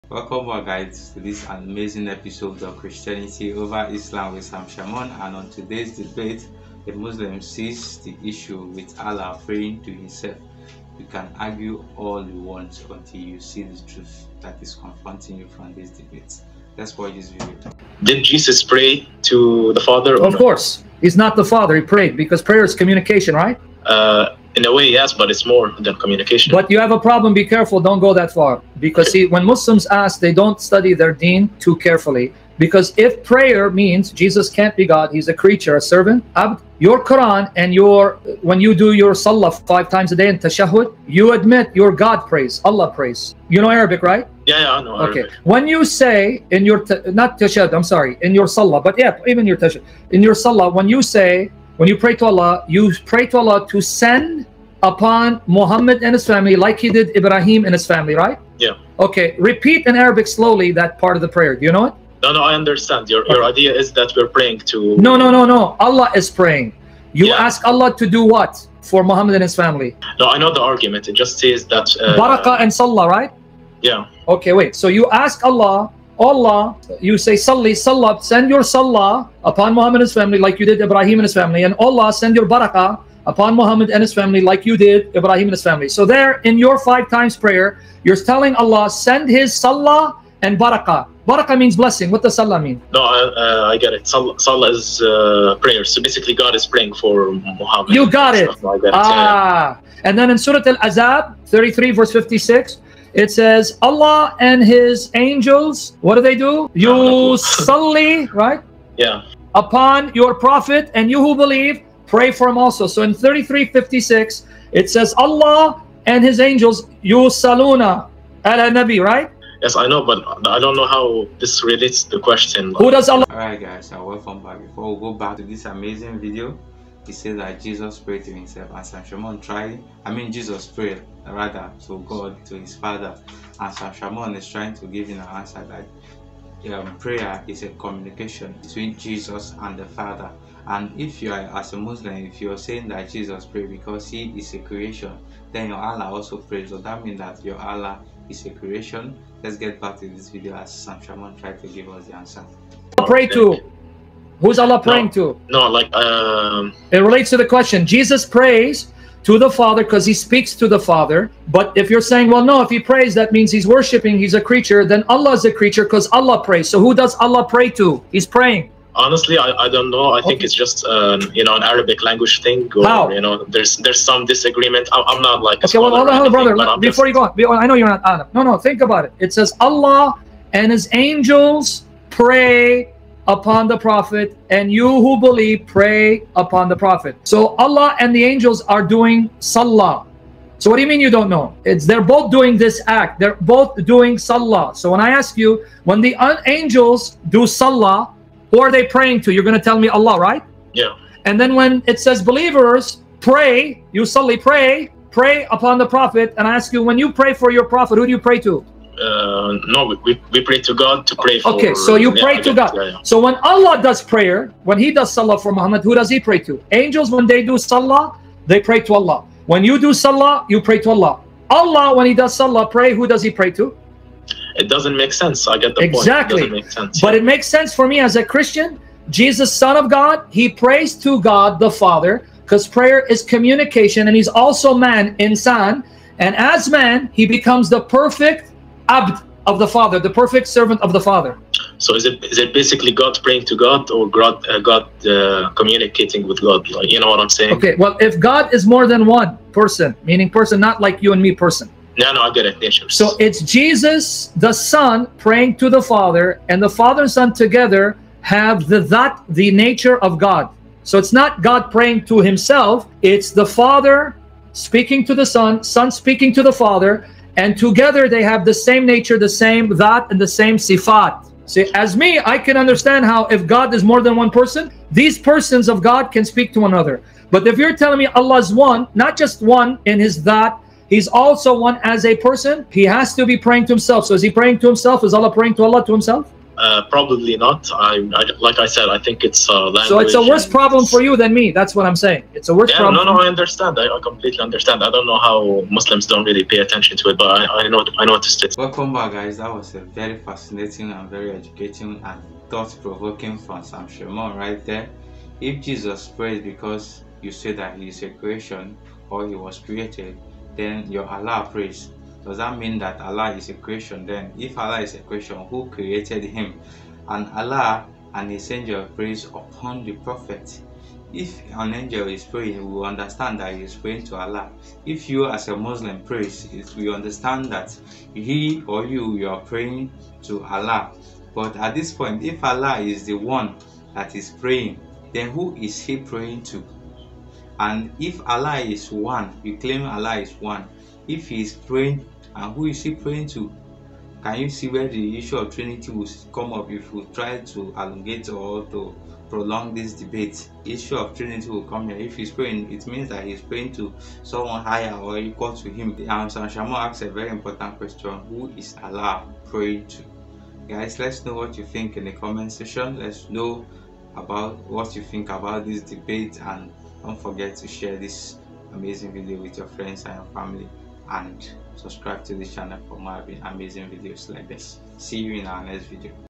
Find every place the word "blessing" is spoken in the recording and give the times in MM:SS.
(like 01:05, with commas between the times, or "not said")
01:31.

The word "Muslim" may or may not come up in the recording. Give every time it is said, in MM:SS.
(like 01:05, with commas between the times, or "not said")
00:06, 00:29, 02:21, 04:55, 05:25.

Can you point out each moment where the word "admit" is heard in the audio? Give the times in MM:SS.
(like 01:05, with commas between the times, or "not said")
00:41.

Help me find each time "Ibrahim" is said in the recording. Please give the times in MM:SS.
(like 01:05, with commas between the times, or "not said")
00:57, 01:20, 01:25.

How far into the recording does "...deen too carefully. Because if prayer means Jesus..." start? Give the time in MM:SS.
00:31.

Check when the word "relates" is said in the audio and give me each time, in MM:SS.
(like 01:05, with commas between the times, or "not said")
02:01, 02:36.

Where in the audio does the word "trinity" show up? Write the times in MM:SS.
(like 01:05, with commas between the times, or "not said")
05:45, 05:51.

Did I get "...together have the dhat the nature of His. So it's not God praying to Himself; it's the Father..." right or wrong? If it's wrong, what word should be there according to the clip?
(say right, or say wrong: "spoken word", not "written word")
wrong: "God", not "His".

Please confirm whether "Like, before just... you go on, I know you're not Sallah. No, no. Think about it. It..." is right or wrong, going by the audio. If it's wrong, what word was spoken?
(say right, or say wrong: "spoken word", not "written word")
wrong: "Arab", not "Sallah".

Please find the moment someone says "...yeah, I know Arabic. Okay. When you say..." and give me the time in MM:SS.
00:44.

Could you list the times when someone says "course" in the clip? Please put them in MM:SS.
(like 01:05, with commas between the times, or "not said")
00:20.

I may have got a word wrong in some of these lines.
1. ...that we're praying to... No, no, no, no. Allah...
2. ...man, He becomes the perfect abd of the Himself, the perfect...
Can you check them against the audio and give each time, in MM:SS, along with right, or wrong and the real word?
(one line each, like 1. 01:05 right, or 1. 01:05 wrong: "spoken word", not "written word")
1. 01:03 right
2. 03:56 wrong: "Father", not "Himself".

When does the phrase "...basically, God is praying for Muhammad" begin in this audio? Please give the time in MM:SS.
01:36.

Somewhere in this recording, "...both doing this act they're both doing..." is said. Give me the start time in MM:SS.
03:12.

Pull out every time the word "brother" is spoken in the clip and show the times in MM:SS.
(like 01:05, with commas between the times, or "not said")
02:56.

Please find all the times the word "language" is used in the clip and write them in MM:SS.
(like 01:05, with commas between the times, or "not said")
02:52, 04:49.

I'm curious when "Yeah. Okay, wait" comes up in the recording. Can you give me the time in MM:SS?
01:13.